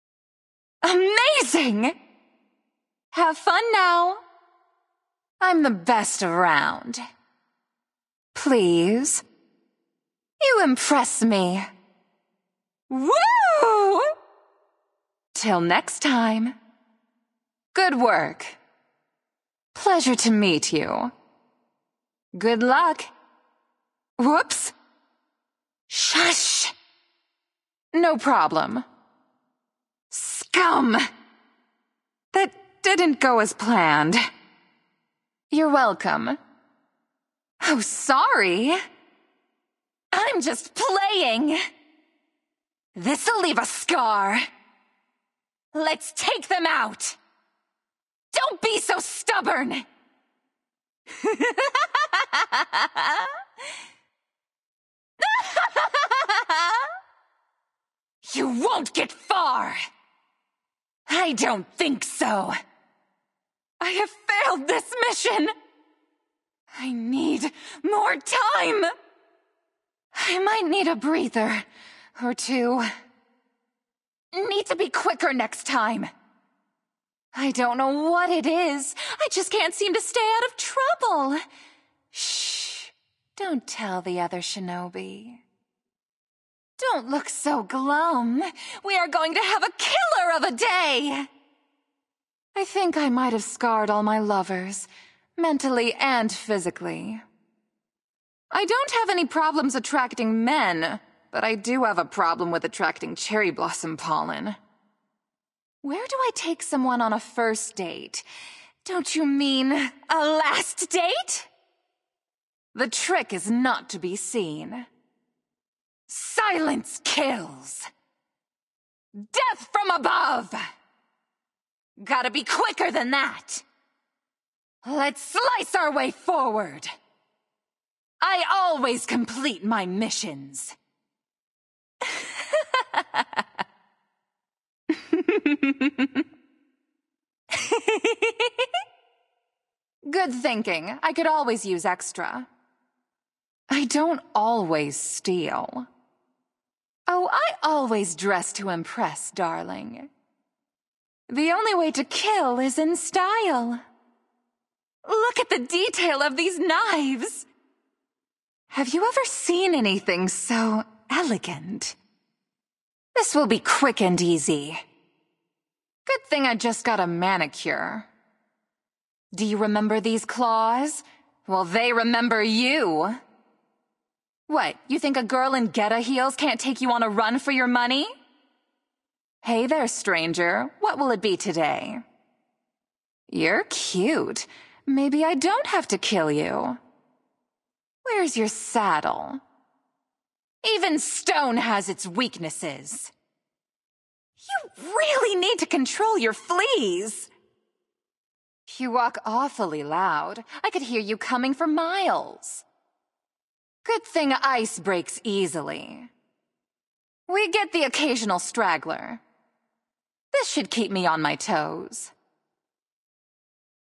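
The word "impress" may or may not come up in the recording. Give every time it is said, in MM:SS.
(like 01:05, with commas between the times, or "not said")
00:10, 02:28.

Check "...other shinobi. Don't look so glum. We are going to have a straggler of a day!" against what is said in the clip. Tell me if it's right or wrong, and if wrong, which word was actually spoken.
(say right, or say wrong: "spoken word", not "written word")
wrong: "killer", not "straggler".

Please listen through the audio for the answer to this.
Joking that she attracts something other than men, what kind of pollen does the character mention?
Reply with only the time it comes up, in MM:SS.
01:43.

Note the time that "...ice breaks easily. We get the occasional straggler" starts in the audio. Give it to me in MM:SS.
03:24.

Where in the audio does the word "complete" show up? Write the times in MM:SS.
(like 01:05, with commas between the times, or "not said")
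02:09.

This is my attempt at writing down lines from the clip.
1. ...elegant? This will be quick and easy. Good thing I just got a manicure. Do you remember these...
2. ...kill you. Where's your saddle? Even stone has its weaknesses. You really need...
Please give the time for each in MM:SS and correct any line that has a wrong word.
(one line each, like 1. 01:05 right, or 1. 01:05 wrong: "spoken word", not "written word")
1. 02:41 right
2. 03:05 right.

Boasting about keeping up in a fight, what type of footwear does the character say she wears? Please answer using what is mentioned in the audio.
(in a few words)
Geta heels.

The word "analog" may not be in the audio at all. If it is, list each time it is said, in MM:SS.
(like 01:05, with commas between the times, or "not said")
not said.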